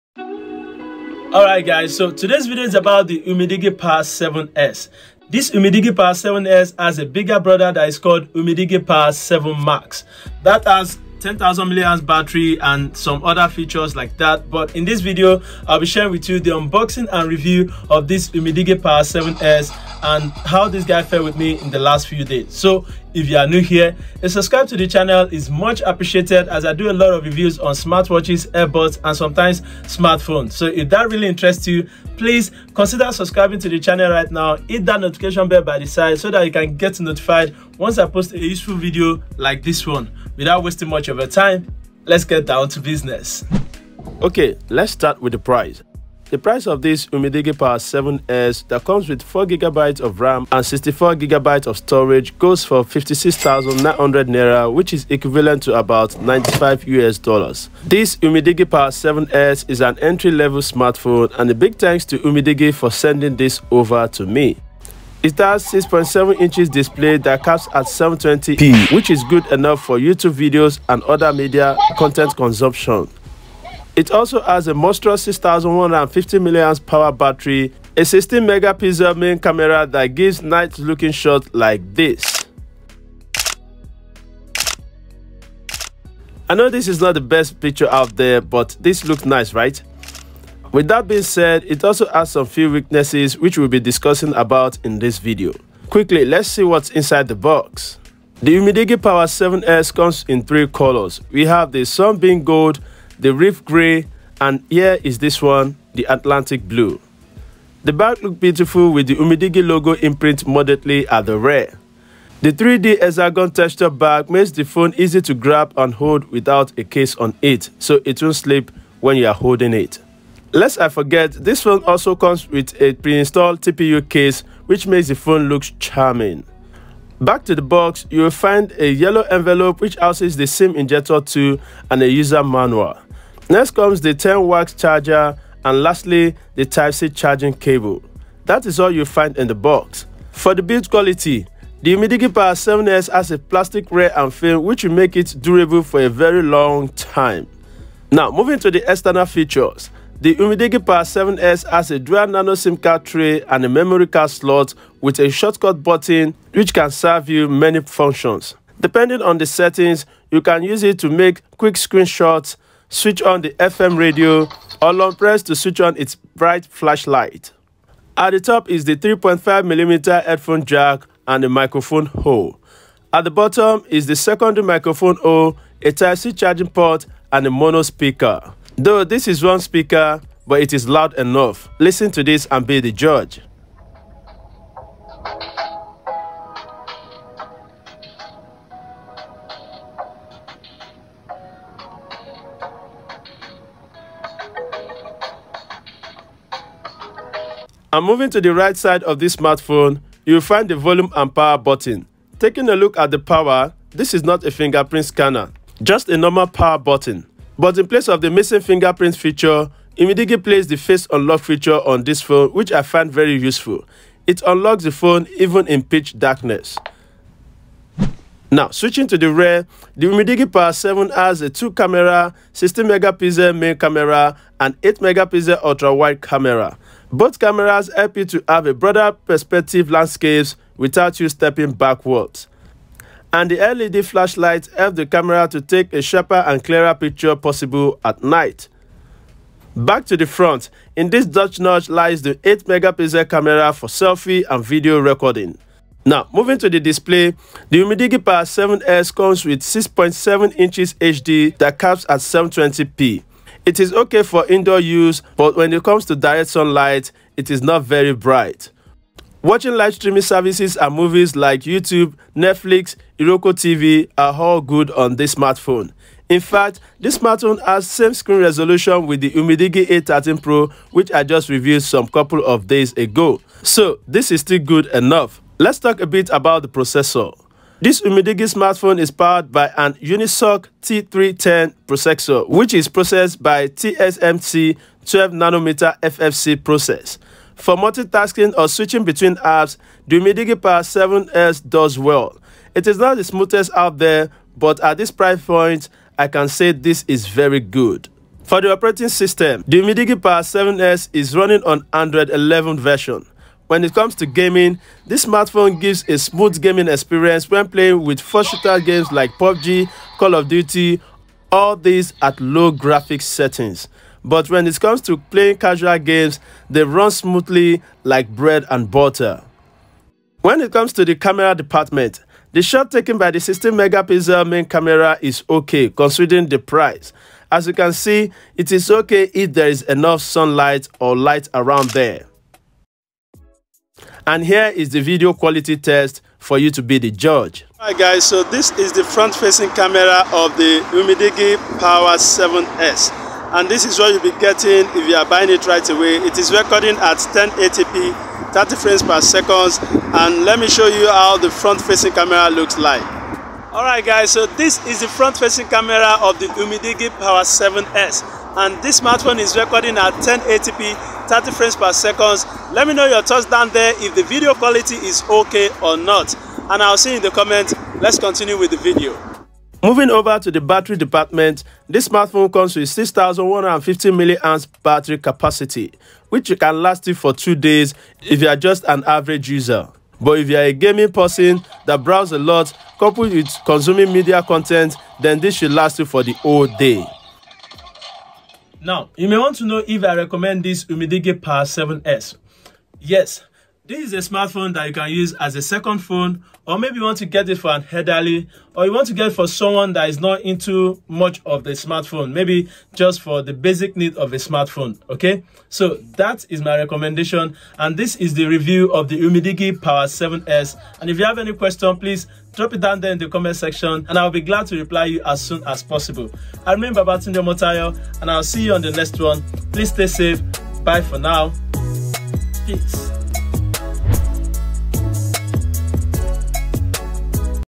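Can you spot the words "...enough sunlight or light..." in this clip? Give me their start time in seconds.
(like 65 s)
329 s.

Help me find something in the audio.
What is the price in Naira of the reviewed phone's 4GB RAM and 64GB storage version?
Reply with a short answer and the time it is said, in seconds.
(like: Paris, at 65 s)
56,900 Naira, at 52 s.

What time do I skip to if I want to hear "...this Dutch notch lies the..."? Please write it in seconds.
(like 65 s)
241 s.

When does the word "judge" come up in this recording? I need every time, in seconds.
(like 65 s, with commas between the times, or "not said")
182 s, 337 s.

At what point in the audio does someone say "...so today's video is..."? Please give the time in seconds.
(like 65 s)
1 s.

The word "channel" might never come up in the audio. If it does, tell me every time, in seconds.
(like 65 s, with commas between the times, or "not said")
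24 s, 33 s.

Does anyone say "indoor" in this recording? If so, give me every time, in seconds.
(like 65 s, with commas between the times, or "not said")
254 s.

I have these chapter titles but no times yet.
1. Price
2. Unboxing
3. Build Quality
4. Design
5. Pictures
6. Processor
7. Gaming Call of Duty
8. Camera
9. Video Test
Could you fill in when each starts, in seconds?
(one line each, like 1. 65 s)
1. 43 s
2. 95 s
3. 140 s
4. 150 s
5. 227 s
6. 246 s
7. 303 s
8. 320 s
9. 337 s.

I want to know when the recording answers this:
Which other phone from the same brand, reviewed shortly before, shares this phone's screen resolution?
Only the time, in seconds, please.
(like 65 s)
269 s.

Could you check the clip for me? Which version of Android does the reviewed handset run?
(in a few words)
Android 11.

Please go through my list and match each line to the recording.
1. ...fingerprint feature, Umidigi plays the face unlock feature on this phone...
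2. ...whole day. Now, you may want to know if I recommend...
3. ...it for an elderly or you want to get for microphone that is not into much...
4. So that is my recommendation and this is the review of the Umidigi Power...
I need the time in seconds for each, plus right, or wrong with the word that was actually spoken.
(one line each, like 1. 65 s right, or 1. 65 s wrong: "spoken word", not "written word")
1. 208 s right
2. 386 s right
3. 397 s wrong: "someone", not "microphone"
4. 405 s right.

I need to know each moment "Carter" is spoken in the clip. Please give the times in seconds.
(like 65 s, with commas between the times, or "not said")
not said.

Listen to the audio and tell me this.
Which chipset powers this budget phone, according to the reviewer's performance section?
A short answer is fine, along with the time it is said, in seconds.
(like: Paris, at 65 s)
Unisoc T310, at 279 s.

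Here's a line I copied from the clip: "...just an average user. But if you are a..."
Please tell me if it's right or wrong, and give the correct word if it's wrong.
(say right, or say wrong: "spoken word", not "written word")
right.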